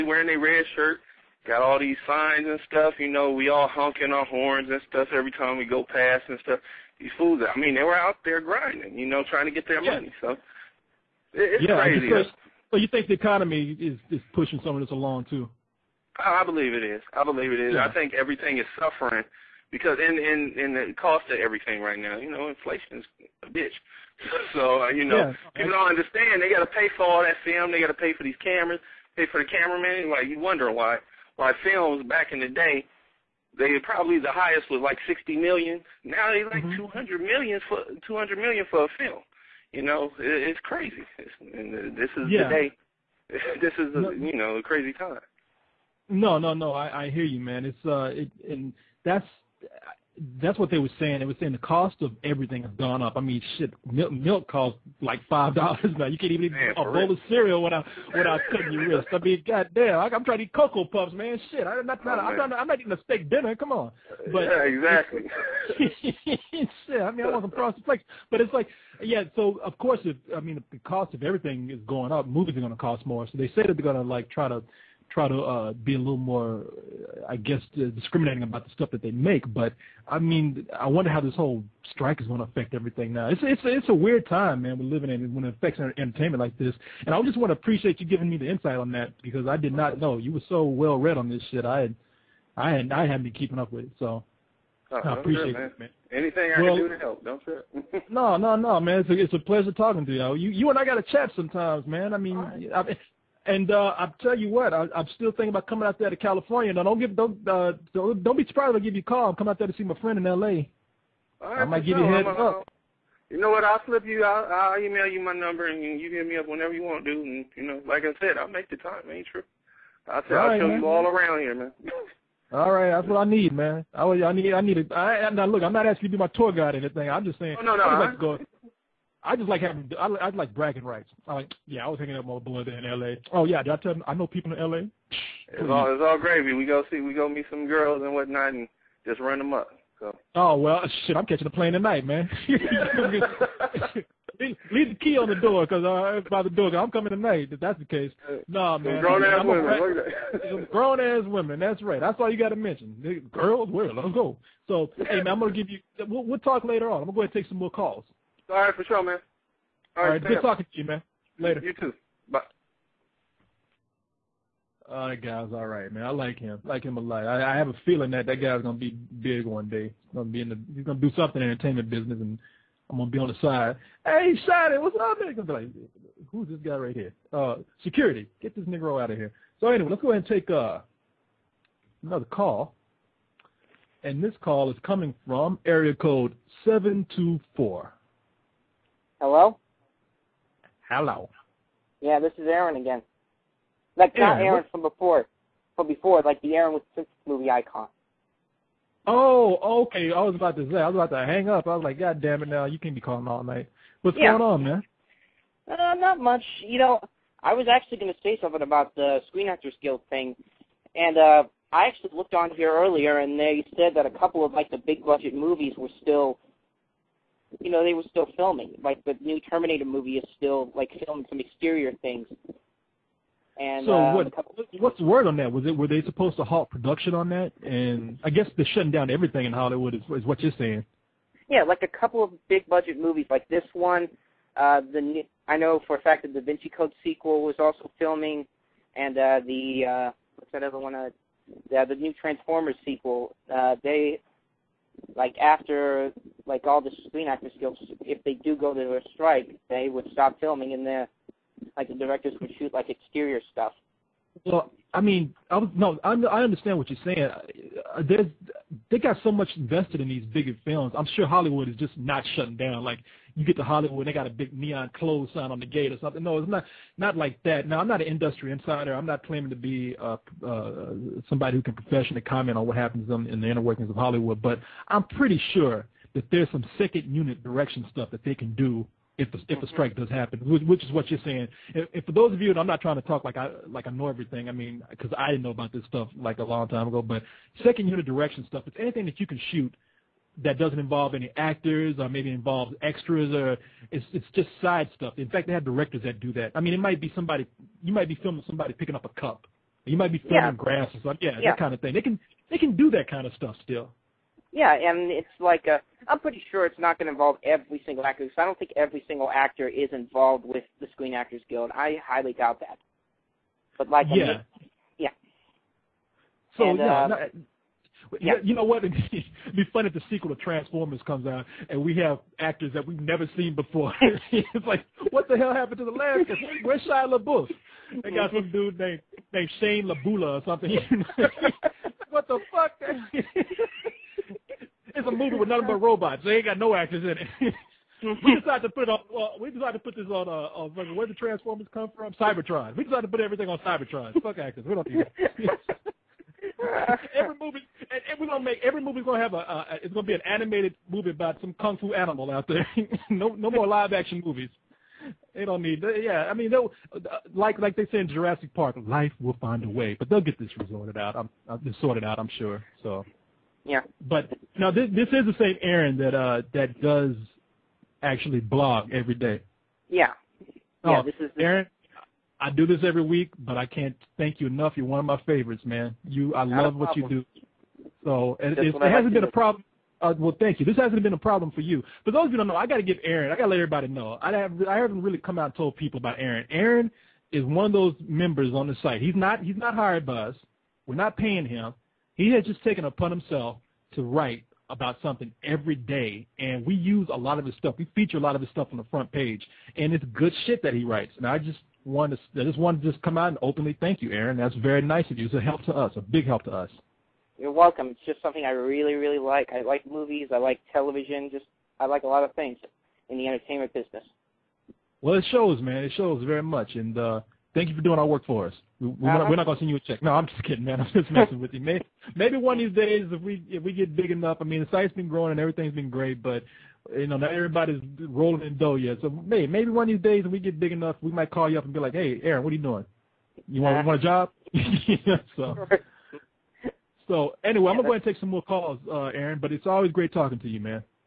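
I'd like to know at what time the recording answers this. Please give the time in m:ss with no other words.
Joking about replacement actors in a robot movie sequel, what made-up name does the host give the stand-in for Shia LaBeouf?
5:29.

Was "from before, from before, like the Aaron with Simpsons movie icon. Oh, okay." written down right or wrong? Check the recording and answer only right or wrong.
right.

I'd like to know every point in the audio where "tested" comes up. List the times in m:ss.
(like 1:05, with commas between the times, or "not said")
not said.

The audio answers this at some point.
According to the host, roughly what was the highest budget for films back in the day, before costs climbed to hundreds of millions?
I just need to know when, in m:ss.
0:35.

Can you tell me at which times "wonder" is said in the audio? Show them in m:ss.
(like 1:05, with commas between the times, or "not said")
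0:30, 1:20.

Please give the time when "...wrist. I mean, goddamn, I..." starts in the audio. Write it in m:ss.
0:58.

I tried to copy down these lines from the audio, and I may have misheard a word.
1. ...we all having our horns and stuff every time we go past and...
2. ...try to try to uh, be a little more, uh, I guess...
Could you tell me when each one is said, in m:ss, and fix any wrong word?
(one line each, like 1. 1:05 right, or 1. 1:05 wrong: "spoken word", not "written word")
1. 0:03 wrong: "honking", not "having"
2. 1:14 right.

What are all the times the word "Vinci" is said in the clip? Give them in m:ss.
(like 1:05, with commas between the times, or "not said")
3:56.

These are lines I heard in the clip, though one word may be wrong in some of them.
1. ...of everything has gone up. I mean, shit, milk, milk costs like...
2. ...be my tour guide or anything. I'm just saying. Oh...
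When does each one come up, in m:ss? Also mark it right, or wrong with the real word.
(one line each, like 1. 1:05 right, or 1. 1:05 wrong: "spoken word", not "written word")
1. 0:52 right
2. 2:06 right.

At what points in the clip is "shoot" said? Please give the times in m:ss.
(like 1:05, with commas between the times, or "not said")
4:12, 4:49.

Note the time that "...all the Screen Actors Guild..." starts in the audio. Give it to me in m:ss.
4:06.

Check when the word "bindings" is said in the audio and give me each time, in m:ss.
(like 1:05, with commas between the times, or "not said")
not said.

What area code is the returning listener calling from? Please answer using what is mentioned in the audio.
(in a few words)
724.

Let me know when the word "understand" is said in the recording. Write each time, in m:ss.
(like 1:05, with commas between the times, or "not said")
0:25, 4:16.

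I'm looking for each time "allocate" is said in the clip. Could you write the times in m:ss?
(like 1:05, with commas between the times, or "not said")
not said.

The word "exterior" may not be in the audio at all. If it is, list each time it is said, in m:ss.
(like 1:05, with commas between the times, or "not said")
3:41, 4:12.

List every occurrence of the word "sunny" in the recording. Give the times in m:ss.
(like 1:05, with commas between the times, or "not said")
not said.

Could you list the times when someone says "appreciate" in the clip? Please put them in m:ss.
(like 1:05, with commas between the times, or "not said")
1:27, 1:35.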